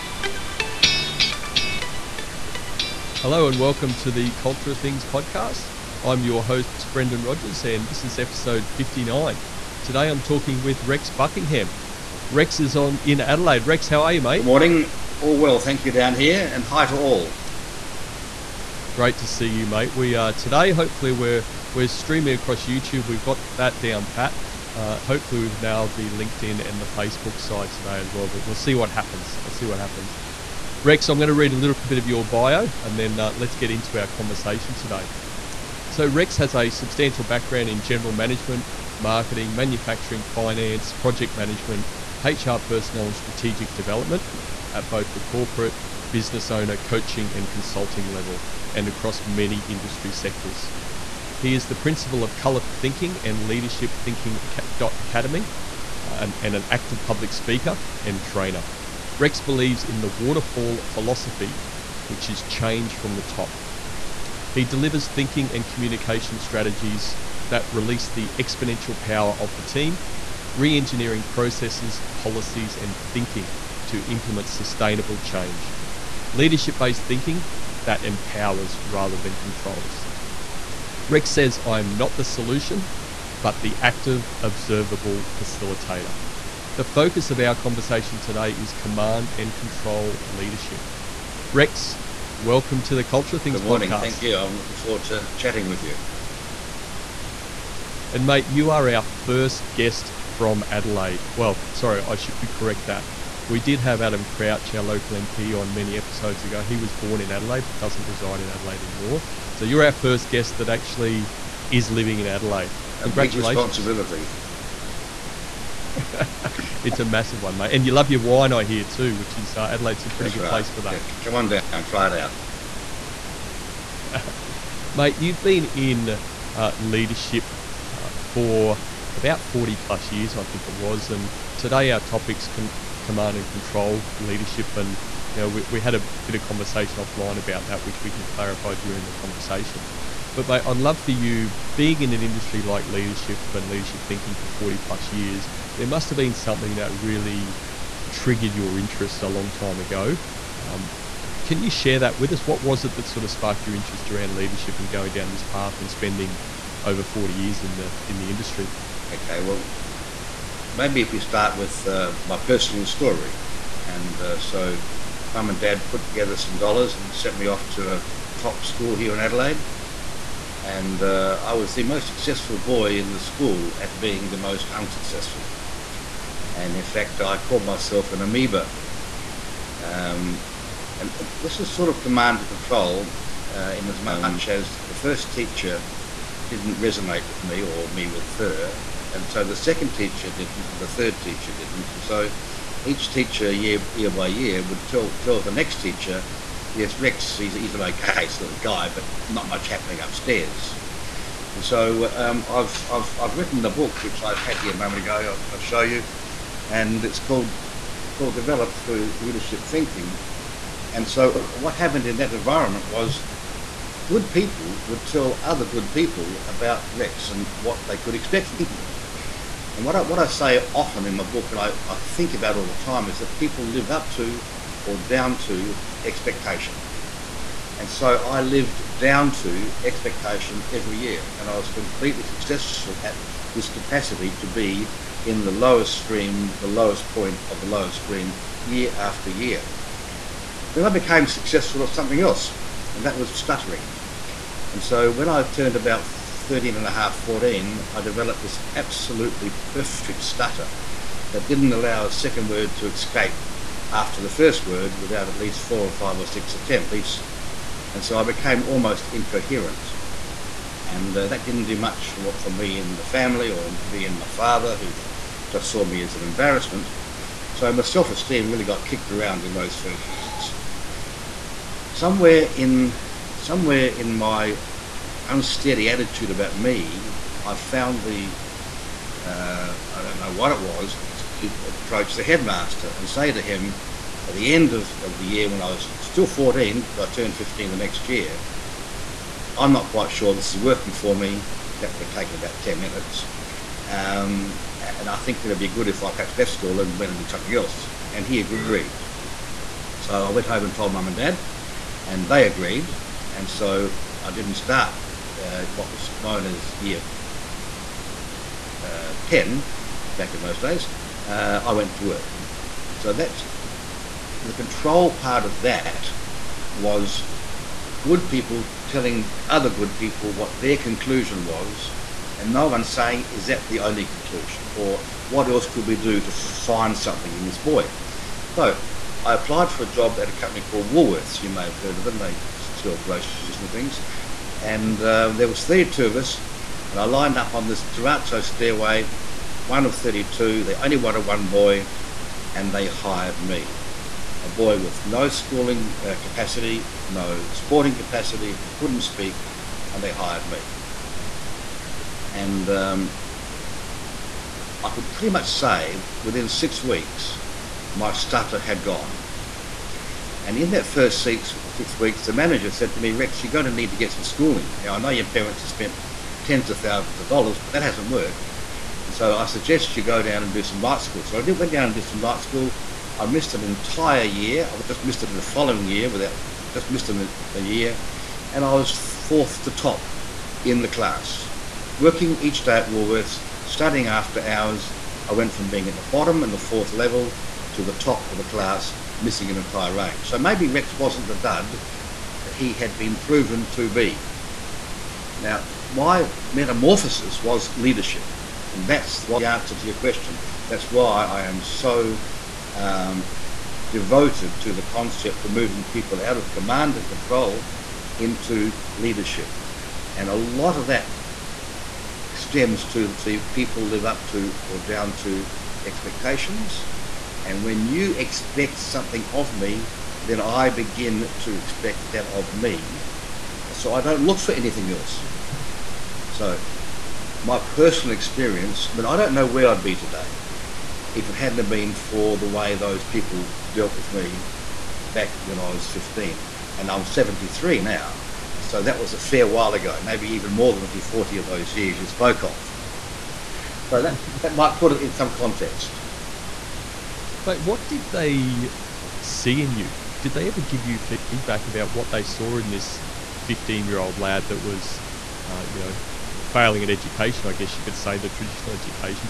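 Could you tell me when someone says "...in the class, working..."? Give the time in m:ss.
6:20.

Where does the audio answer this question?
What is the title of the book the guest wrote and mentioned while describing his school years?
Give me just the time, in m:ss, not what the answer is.
3:28.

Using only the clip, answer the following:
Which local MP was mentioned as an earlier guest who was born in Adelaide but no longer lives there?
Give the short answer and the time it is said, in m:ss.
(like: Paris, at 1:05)
Adam Crouch, at 1:44.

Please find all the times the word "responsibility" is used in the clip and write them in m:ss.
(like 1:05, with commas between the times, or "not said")
1:53.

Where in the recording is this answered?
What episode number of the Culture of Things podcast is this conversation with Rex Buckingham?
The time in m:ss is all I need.
0:08.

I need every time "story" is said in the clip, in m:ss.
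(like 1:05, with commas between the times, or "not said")
2:42.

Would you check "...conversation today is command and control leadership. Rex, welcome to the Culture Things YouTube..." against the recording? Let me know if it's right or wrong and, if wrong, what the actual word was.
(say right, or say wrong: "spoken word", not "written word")
wrong: "Good", not "YouTube".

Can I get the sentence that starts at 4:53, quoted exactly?
Um, and I think it'd be good if I perhaps left school and went and did something else.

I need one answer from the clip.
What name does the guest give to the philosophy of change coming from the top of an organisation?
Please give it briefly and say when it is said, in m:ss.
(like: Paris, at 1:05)
waterfall philosophy, at 1:00.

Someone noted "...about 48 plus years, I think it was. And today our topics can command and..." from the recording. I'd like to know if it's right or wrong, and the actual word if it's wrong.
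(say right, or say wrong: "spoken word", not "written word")
wrong: "40", not "48".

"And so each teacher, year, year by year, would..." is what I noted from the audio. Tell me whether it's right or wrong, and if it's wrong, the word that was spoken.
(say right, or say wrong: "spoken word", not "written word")
right.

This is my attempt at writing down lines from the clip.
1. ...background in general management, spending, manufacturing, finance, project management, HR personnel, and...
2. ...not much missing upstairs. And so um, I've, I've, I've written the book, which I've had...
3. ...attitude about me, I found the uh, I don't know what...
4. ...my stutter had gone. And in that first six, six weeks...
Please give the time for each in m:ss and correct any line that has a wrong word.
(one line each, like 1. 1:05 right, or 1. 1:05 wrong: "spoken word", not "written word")
1. 0:37 wrong: "marketing", not "spending"
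2. 3:19 wrong: "happening", not "missing"
3. 4:35 right
4. 5:57 right.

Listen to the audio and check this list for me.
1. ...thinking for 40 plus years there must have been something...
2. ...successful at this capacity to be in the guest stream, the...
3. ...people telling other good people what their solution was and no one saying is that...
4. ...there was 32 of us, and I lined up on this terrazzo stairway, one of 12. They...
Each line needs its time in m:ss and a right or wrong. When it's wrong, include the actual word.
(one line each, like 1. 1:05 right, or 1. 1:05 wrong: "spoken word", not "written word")
1. 2:24 right
2. 3:52 wrong: "lowest", not "guest"
3. 5:18 wrong: "conclusion", not "solution"
4. 5:35 wrong: "32", not "12".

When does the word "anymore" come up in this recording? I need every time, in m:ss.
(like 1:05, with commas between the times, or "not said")
1:48.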